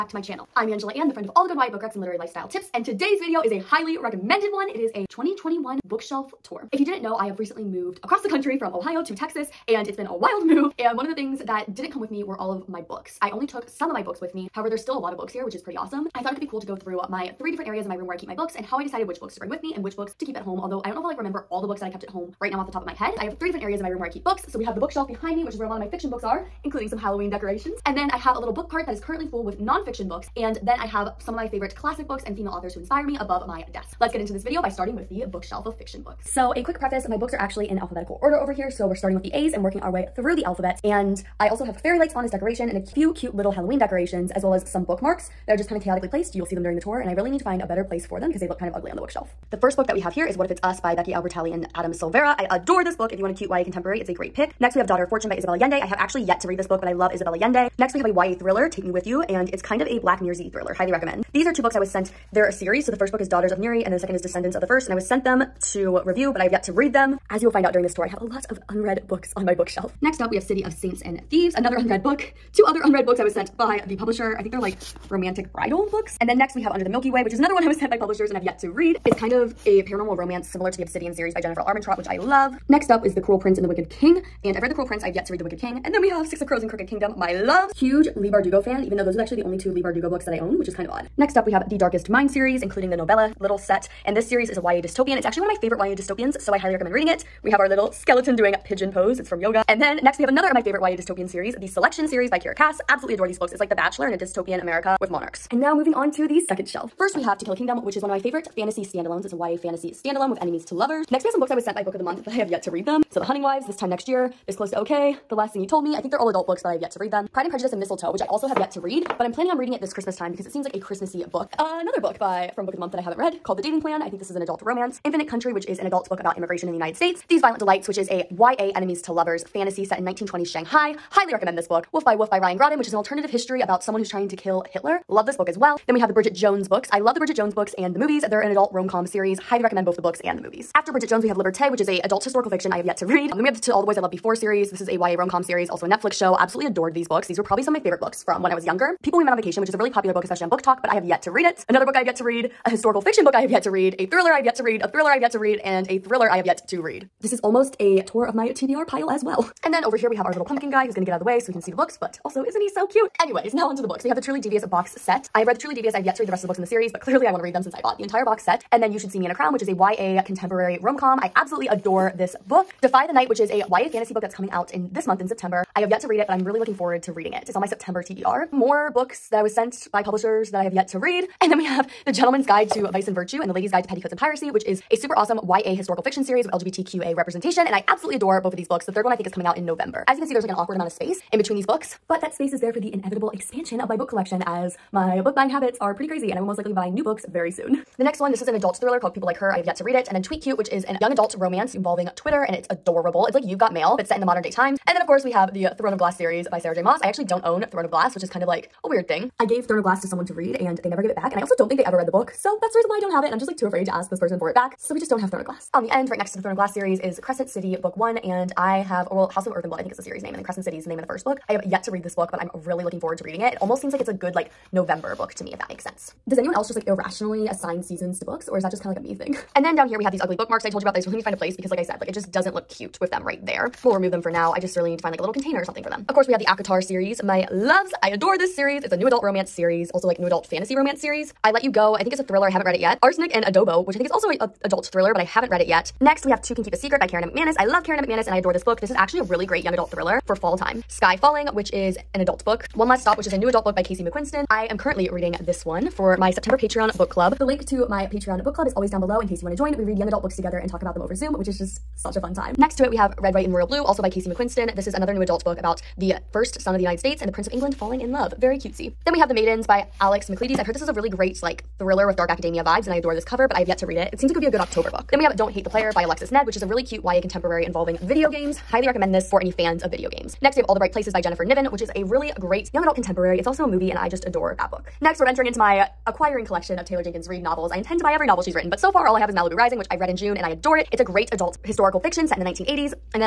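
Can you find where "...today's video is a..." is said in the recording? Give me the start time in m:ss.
0:02.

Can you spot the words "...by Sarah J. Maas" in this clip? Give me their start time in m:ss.
3:26.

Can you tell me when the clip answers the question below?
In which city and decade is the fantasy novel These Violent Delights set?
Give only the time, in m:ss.
2:10.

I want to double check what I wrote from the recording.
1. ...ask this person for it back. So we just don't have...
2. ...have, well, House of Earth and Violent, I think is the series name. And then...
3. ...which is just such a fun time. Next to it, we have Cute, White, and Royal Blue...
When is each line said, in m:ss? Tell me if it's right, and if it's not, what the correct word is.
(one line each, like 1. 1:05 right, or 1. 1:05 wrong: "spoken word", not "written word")
1. 3:33 right
2. 3:38 wrong: "Blood", not "Violent"
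3. 4:21 wrong: "Red", not "Cute".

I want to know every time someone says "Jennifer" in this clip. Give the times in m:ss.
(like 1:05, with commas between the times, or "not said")
1:21, 4:41.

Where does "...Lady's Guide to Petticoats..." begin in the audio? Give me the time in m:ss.
3:03.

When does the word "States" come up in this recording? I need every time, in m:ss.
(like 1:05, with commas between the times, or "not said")
2:06, 4:26.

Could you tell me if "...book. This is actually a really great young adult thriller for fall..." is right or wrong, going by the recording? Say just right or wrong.
right.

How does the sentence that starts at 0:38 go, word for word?
So we're starting with the A's and working our way through the alphabet.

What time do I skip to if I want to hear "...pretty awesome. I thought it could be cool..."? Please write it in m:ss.
0:15.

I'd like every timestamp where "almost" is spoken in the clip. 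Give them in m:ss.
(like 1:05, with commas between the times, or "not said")
2:37, 3:43.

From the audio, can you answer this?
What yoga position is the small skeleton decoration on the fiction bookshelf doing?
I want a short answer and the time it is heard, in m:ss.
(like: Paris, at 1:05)
pigeon pose, at 1:38.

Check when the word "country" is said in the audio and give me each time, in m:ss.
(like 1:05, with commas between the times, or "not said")
0:08, 2:05.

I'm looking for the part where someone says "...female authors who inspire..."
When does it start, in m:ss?
0:32.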